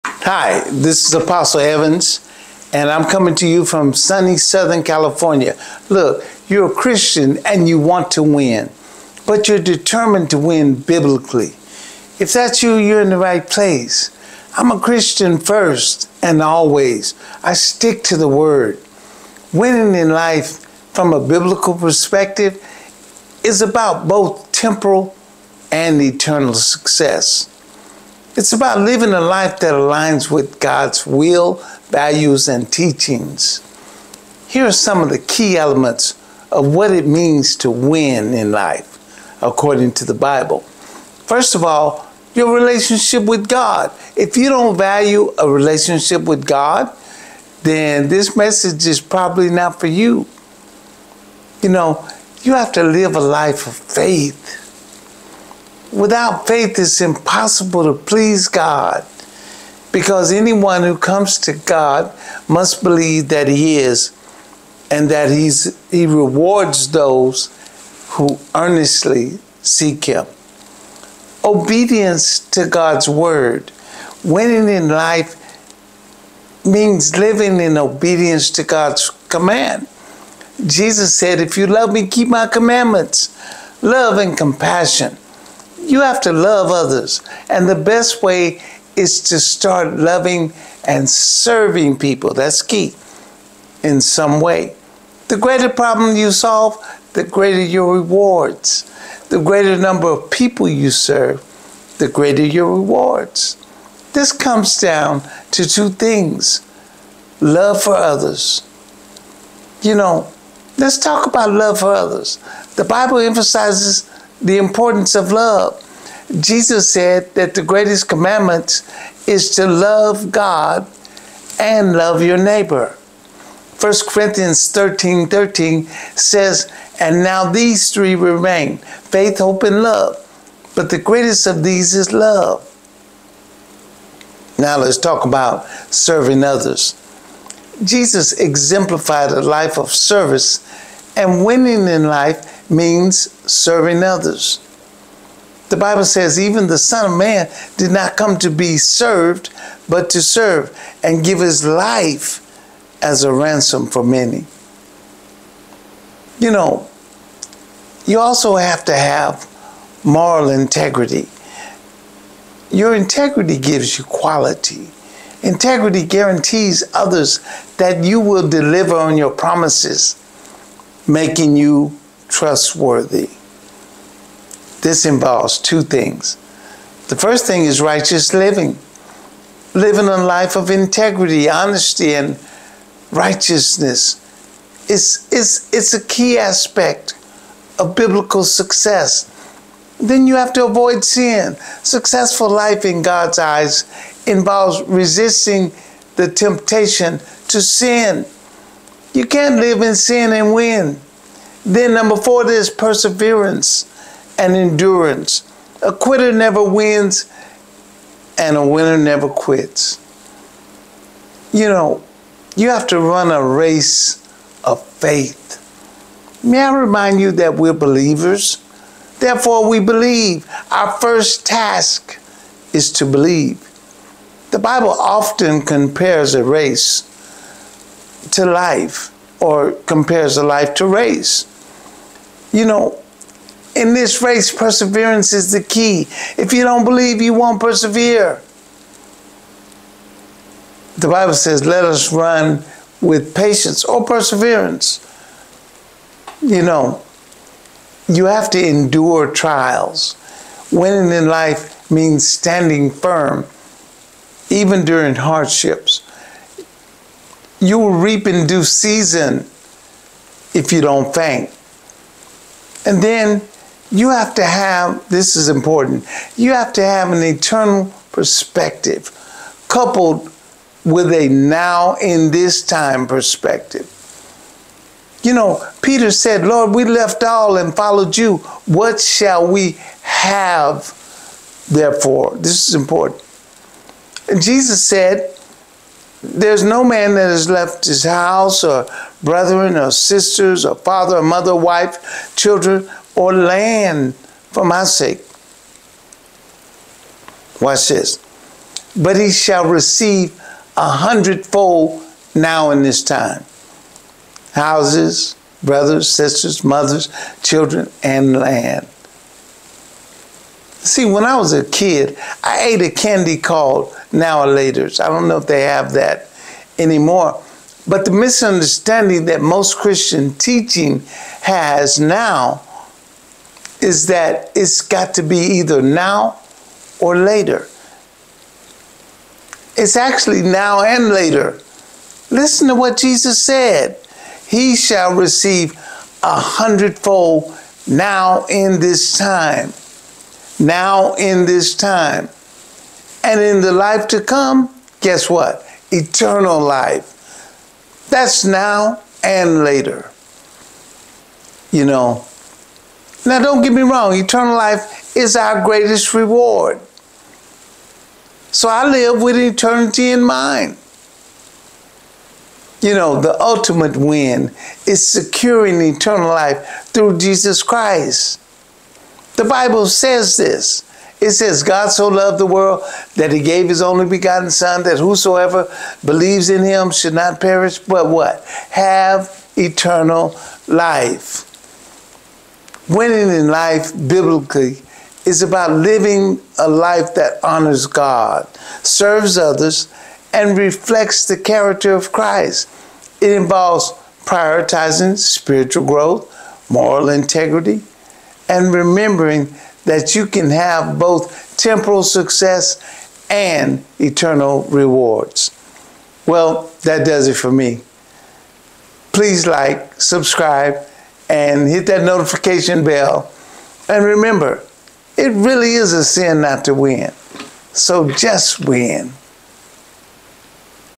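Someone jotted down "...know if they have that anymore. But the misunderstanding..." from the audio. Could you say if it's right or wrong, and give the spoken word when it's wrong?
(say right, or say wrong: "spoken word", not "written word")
right.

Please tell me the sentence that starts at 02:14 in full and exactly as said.
Now let's talk about serving others.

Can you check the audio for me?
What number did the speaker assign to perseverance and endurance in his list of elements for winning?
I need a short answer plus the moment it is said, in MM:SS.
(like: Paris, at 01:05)
4, at 03:22.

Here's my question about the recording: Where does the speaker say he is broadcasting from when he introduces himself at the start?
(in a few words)
Southern California.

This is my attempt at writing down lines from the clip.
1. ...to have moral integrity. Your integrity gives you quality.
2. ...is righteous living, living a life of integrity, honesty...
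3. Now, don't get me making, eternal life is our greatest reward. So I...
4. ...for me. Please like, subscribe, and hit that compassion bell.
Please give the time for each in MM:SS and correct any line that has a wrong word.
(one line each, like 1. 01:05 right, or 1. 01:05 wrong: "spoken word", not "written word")
1. 02:38 right
2. 02:57 right
3. 05:53 wrong: "wrong", not "making"
4. 06:47 wrong: "notification", not "compassion".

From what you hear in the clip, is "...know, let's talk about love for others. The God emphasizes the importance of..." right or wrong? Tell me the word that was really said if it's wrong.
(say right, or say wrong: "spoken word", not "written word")
wrong: "Bible", not "God".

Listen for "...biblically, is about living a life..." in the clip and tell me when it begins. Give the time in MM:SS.
06:23.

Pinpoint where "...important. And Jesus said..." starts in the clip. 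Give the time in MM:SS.
04:42.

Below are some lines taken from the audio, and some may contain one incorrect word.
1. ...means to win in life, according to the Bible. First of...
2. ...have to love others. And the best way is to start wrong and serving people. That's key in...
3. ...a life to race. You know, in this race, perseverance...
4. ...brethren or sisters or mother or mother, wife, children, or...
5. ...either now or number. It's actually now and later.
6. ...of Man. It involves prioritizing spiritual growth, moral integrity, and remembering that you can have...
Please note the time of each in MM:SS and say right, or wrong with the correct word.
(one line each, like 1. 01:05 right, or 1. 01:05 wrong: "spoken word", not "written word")
1. 00:37 right
2. 01:26 wrong: "loving", not "wrong"
3. 03:50 right
4. 04:49 wrong: "father", not "mother"
5. 05:25 wrong: "later", not "number"
6. 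06:31 wrong: "Christ", not "Man".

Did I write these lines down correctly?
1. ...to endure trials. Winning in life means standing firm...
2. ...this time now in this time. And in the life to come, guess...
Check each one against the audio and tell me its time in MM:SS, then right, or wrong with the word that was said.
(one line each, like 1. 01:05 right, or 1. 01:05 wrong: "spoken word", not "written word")
1. 04:08 right
2. 05:38 right.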